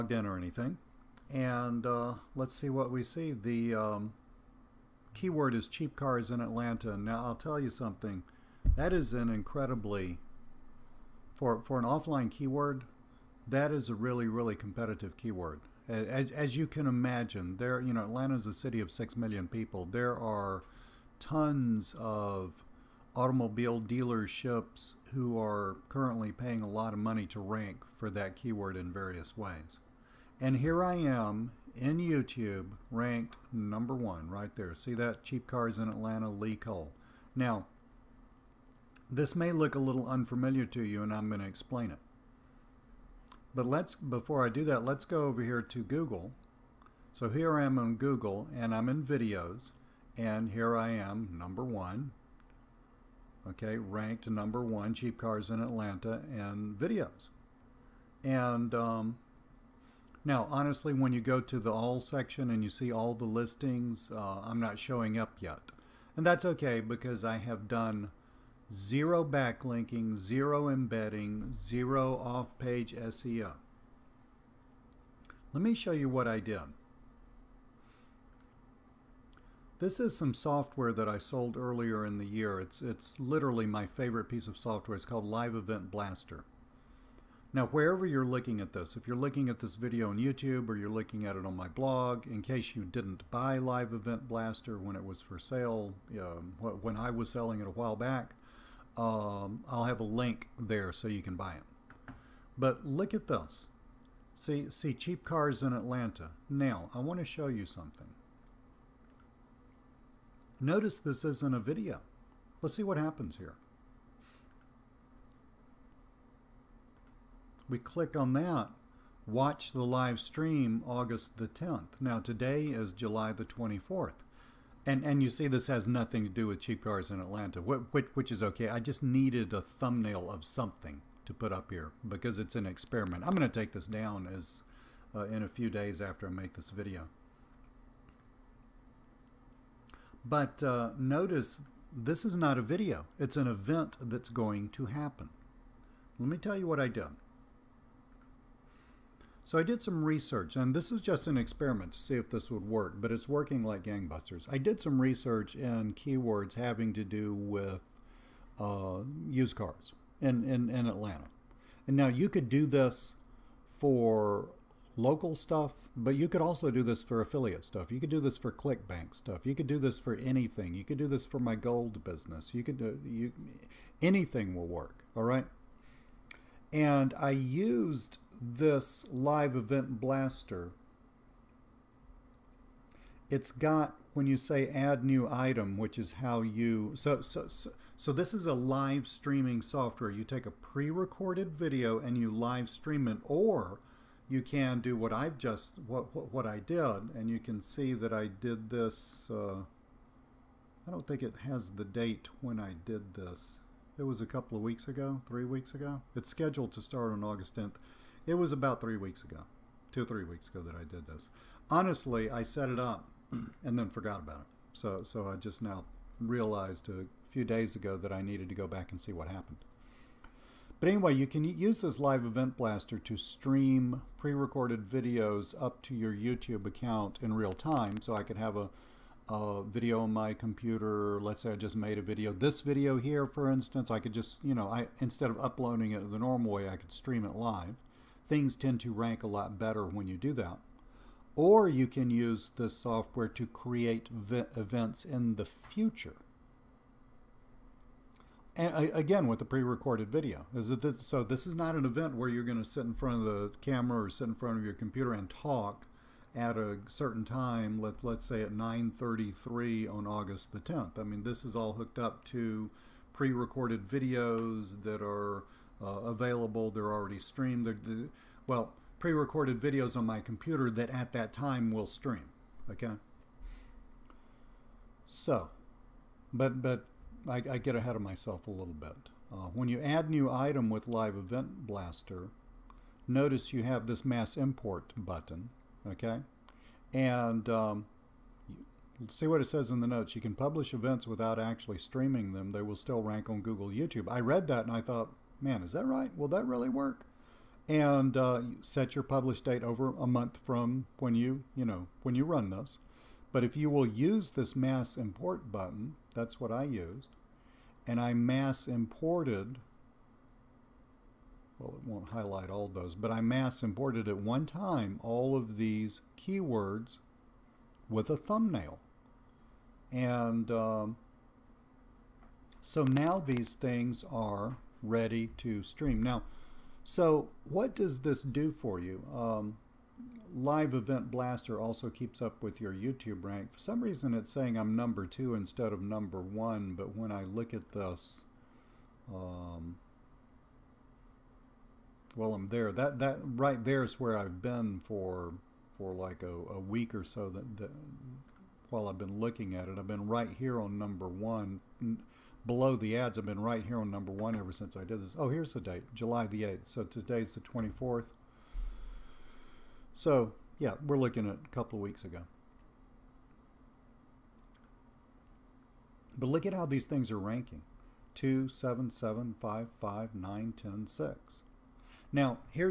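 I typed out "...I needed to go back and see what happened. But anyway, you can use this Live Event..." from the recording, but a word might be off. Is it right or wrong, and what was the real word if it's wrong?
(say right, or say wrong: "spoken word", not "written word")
right.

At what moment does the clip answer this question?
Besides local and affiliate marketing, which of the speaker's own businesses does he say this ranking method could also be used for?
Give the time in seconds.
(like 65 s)
171 s.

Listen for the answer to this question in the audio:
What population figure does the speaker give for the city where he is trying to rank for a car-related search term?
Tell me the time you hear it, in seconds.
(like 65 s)
18 s.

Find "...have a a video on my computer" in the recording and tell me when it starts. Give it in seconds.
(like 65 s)
228 s.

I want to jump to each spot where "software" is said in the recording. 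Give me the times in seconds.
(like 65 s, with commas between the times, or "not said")
80 s, 84 s, 189 s, 242 s.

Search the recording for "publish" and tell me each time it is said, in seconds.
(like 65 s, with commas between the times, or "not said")
290 s, 299 s.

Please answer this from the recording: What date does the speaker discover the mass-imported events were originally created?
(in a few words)
July 8th.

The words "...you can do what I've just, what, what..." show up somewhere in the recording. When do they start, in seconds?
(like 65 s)
194 s.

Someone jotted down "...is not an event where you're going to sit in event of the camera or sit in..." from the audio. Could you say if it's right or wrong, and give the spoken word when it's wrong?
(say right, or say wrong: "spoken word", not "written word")
wrong: "front", not "event".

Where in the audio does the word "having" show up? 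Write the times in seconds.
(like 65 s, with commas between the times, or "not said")
156 s.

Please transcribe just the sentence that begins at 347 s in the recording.
That, that while I've been looking at it, I've been right here on number one.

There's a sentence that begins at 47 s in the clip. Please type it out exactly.
So here I am on Google, and I'm in videos, and here I am, number one.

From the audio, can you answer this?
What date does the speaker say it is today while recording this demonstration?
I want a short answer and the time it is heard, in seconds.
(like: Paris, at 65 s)
July 24th, at 122 s.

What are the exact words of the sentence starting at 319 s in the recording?
And um, so now these things are ready to stream.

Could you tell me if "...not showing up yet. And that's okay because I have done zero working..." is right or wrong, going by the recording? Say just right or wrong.
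wrong.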